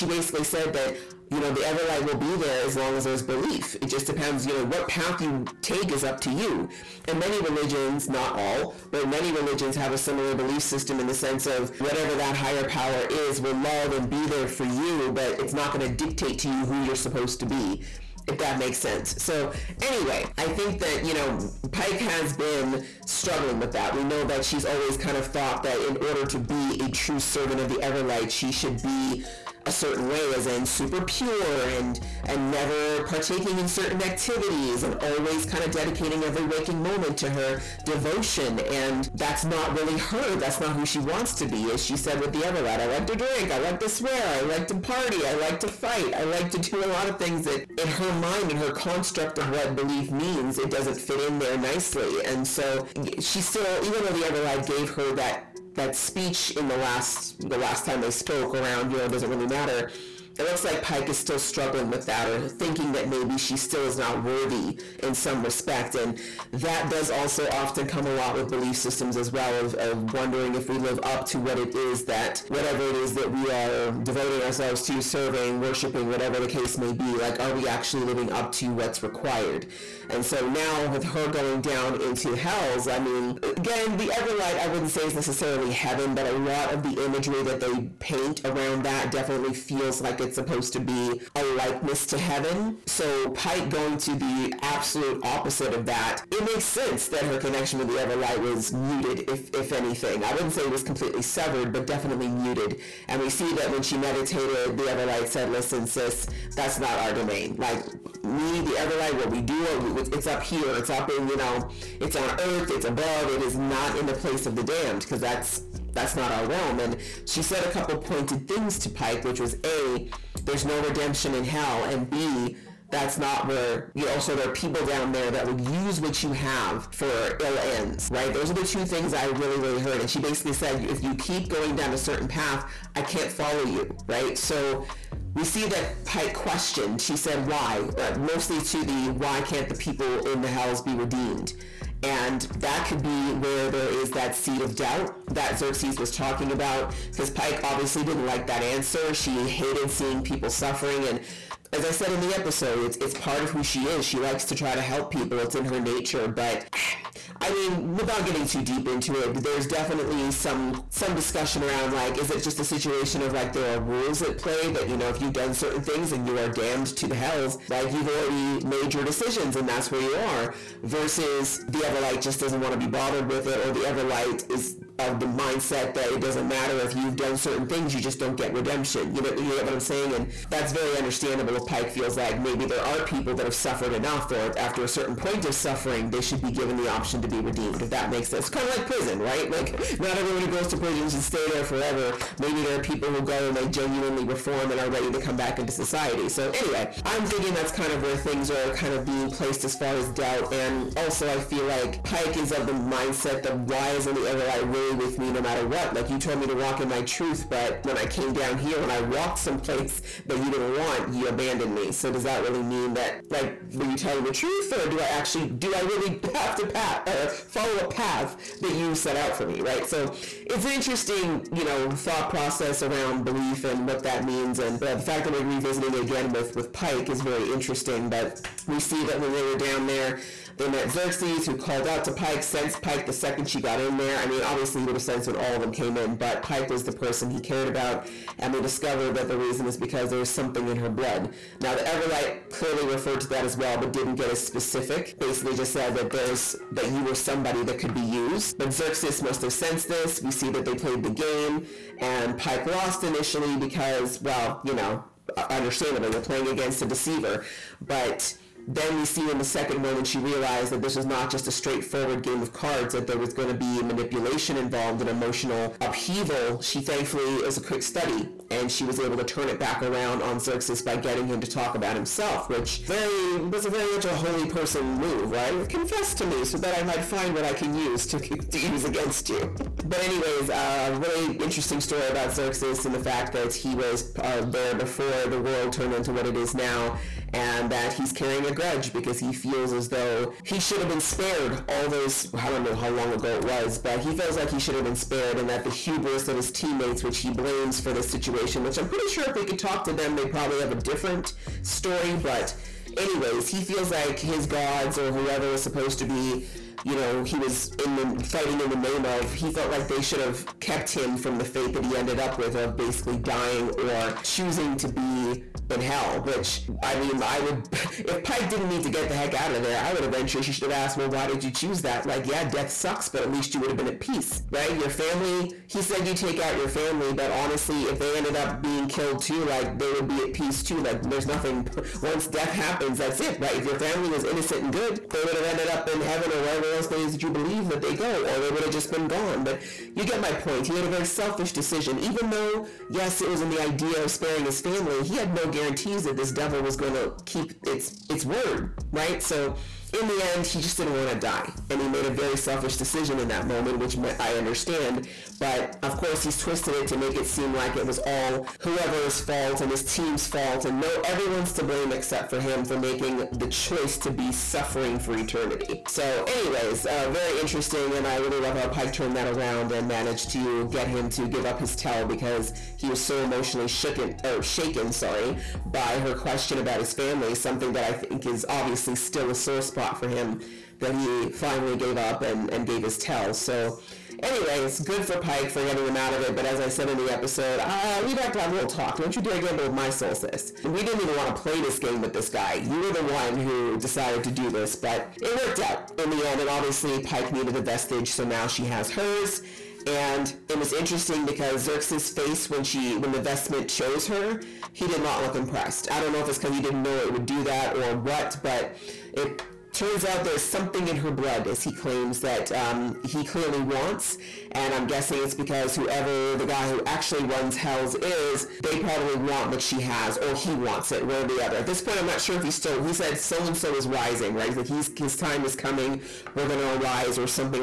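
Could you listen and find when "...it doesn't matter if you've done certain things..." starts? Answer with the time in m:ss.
2:56.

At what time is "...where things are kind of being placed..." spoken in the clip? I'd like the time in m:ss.
3:18.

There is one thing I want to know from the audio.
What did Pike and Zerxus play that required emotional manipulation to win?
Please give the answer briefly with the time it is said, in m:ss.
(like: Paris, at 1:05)
cards, at 4:22.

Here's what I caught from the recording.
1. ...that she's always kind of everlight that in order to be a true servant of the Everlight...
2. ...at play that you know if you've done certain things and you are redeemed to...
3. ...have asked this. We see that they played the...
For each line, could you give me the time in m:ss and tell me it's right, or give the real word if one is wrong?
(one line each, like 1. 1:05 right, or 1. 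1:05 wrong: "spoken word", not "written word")
1. 0:24 wrong: "thought", not "everlight"
2. 2:44 wrong: "damned", not "redeemed"
3. 4:09 wrong: "sensed", not "asked".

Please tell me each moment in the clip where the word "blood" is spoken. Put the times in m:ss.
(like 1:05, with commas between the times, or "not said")
4:00, 6:51.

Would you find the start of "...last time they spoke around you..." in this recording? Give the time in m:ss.
0:57.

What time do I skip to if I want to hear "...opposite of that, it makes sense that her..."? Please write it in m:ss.
1:35.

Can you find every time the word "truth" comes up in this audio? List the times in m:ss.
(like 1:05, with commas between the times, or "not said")
3:27, 3:34.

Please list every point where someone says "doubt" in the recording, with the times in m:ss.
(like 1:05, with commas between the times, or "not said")
2:24, 3:20.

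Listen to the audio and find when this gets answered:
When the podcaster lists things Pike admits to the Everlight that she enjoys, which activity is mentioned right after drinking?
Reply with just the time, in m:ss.
0:43.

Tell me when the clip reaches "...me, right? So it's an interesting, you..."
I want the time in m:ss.
3:39.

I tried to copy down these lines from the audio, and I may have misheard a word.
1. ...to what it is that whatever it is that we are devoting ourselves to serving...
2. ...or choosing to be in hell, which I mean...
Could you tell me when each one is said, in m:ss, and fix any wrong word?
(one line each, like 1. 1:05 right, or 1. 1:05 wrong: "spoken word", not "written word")
1. 1:11 right
2. 5:13 right.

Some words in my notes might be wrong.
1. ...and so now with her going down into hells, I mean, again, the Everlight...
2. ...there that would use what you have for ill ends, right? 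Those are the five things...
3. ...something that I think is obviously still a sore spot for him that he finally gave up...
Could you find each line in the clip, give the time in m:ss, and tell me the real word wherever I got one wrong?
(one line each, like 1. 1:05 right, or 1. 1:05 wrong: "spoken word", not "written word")
1. 1:20 right
2. 2:05 wrong: "two", not "five"
3. 6:17 right.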